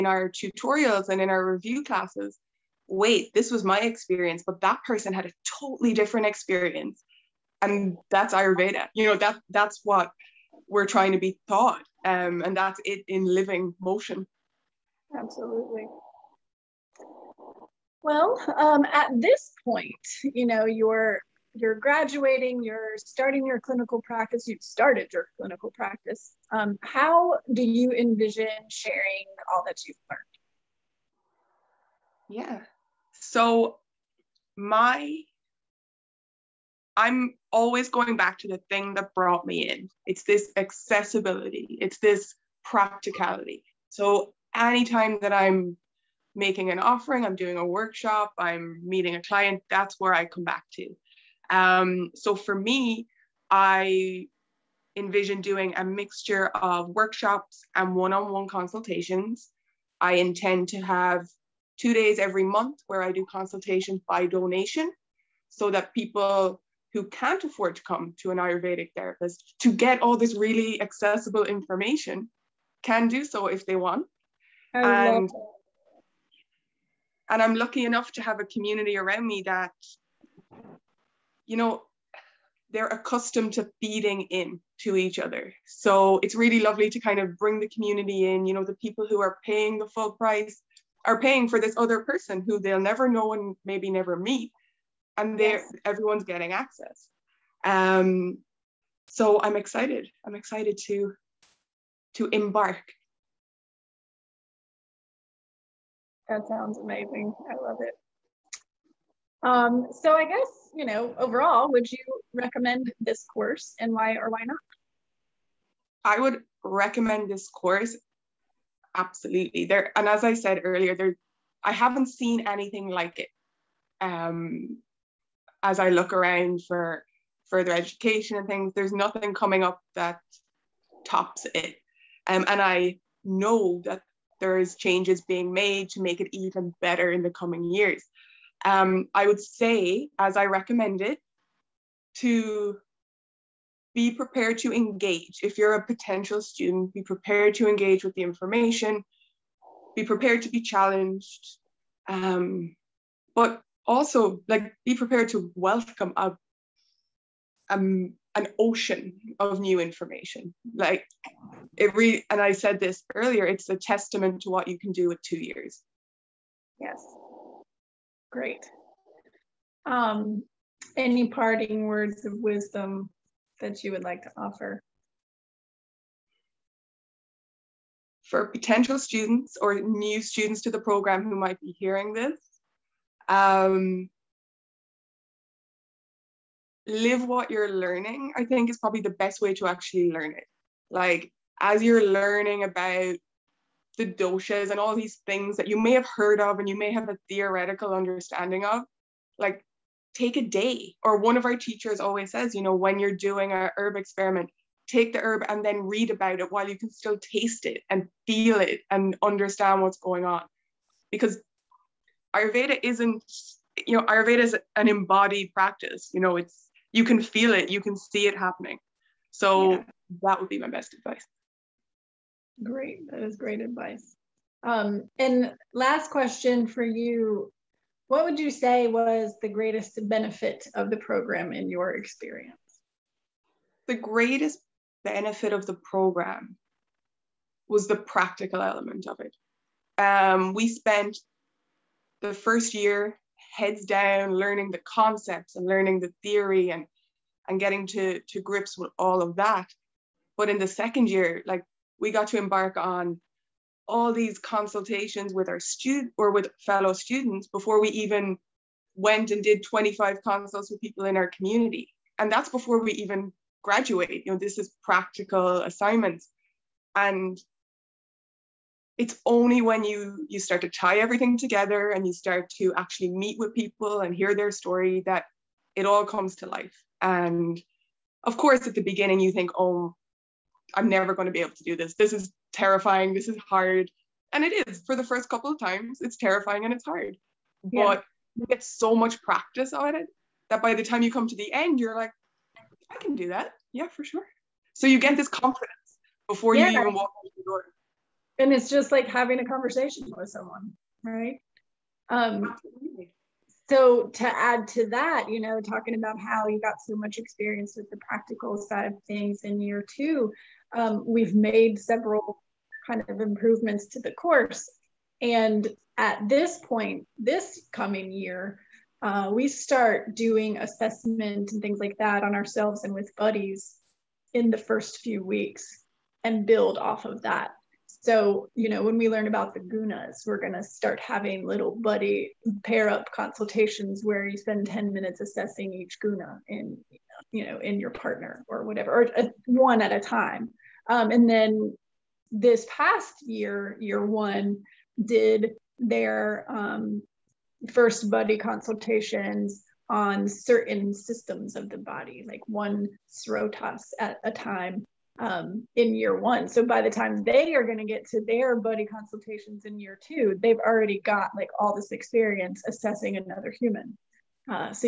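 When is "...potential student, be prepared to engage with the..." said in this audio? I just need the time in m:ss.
2:25.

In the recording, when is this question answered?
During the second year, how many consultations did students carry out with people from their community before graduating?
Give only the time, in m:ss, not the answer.
4:19.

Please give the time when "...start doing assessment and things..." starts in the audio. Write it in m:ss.
5:19.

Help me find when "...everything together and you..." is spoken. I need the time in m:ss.
4:30.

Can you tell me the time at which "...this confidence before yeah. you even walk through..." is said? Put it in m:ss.
4:55.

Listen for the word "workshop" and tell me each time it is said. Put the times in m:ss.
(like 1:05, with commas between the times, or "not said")
0:47, 0:56.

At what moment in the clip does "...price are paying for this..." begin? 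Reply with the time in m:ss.
1:30.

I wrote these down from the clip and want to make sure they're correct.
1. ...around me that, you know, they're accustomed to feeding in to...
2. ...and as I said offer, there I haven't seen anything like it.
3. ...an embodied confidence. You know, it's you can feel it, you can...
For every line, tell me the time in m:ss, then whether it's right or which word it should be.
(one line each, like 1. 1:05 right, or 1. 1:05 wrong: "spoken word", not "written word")
1. 1:18 right
2. 1:59 wrong: "earlier", not "offer"
3. 3:34 wrong: "practice", not "confidence".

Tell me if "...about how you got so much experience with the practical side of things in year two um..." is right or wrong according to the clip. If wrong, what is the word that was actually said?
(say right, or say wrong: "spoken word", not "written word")
right.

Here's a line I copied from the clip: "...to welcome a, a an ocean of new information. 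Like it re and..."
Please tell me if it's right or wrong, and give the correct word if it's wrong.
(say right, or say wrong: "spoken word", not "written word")
right.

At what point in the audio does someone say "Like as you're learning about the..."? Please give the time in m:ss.
3:10.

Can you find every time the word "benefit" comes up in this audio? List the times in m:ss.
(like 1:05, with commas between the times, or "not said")
3:50, 3:55.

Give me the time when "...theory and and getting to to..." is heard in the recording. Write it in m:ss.
4:06.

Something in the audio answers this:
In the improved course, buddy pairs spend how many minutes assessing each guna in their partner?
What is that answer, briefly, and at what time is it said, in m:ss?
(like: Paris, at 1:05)
10 minutes, at 5:34.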